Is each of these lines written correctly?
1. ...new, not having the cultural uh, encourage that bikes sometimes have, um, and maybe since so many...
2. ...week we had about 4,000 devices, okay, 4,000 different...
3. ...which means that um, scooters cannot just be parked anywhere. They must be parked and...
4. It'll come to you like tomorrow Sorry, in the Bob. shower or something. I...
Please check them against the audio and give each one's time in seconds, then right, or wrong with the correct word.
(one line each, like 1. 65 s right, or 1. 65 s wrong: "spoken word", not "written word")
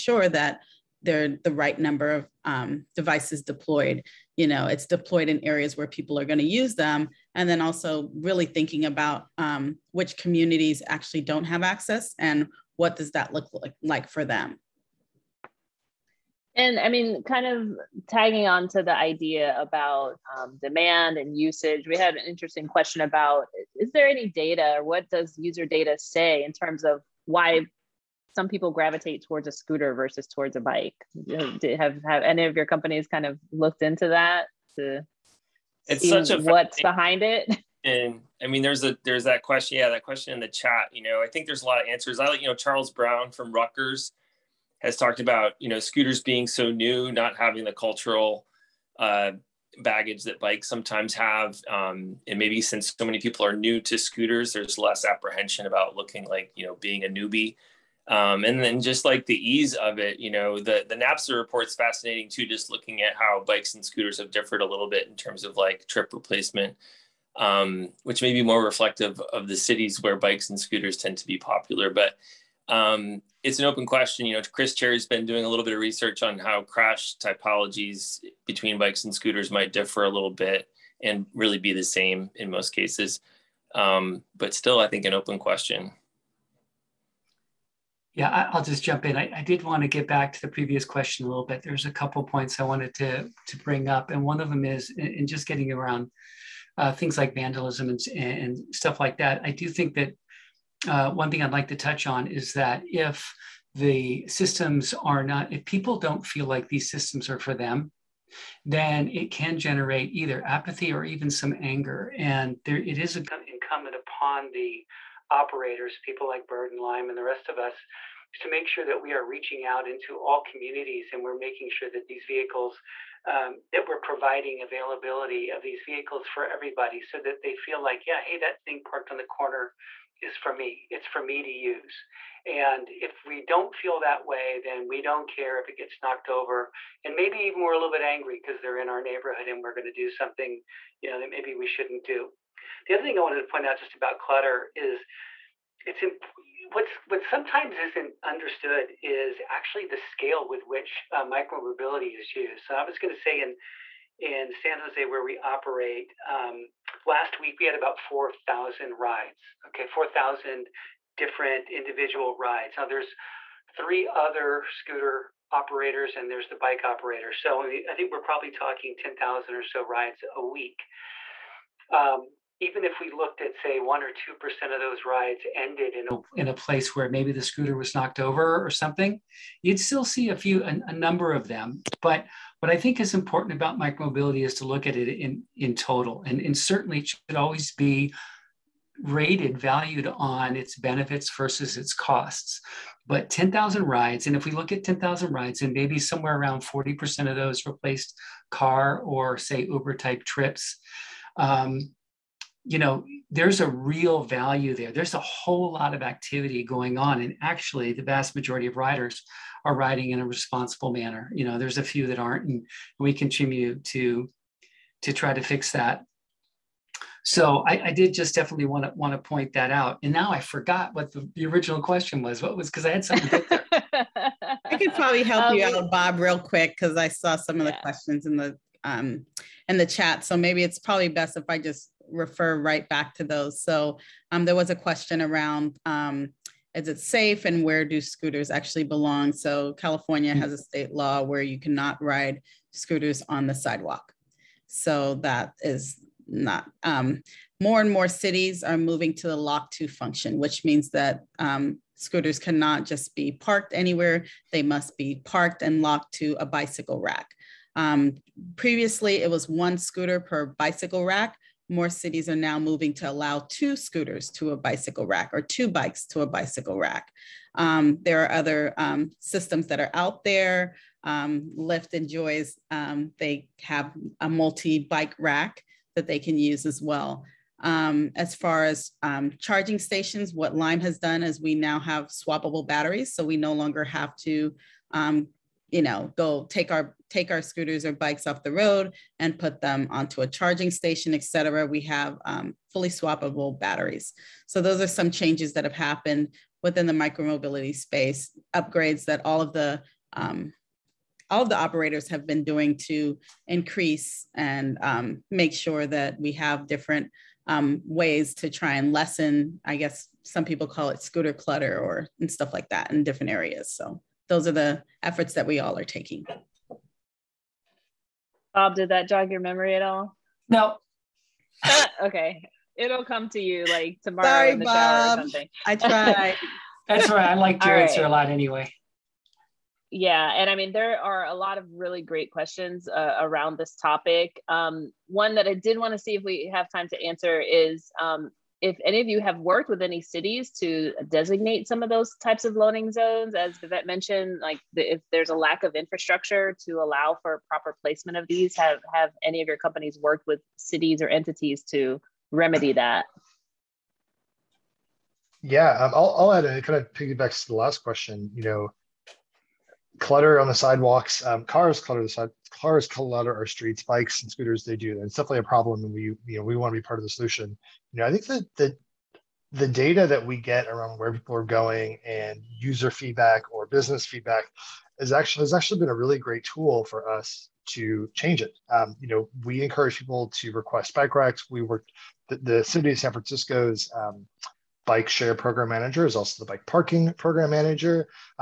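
1. 46 s wrong: "baggage", not "encourage"
2. 157 s wrong: "rides", not "devices"
3. 250 s right
4. 322 s right.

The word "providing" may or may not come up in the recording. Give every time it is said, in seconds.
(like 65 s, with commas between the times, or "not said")
123 s.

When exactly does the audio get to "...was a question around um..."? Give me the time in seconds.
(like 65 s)
234 s.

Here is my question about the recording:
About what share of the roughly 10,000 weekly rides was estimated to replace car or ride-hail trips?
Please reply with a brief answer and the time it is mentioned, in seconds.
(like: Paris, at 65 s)
40%, at 196 s.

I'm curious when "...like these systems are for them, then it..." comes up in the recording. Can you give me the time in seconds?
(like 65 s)
106 s.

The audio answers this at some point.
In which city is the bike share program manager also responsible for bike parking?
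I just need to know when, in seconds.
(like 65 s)
382 s.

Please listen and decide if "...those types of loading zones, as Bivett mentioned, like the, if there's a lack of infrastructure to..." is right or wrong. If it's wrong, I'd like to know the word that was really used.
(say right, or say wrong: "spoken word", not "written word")
right.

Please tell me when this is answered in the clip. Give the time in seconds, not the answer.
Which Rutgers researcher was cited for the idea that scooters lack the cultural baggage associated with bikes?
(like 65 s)
42 s.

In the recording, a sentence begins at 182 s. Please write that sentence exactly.
But what I think is important about micromobility is to look at it in, in total.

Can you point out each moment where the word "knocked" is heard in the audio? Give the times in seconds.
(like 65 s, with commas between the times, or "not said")
136 s, 177 s.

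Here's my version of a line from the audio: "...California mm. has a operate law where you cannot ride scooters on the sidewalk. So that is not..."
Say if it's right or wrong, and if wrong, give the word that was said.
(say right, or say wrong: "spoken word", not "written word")
wrong: "state", not "operate".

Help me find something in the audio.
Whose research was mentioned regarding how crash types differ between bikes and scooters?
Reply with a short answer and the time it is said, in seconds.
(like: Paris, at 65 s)
Chris Cherry, at 74 s.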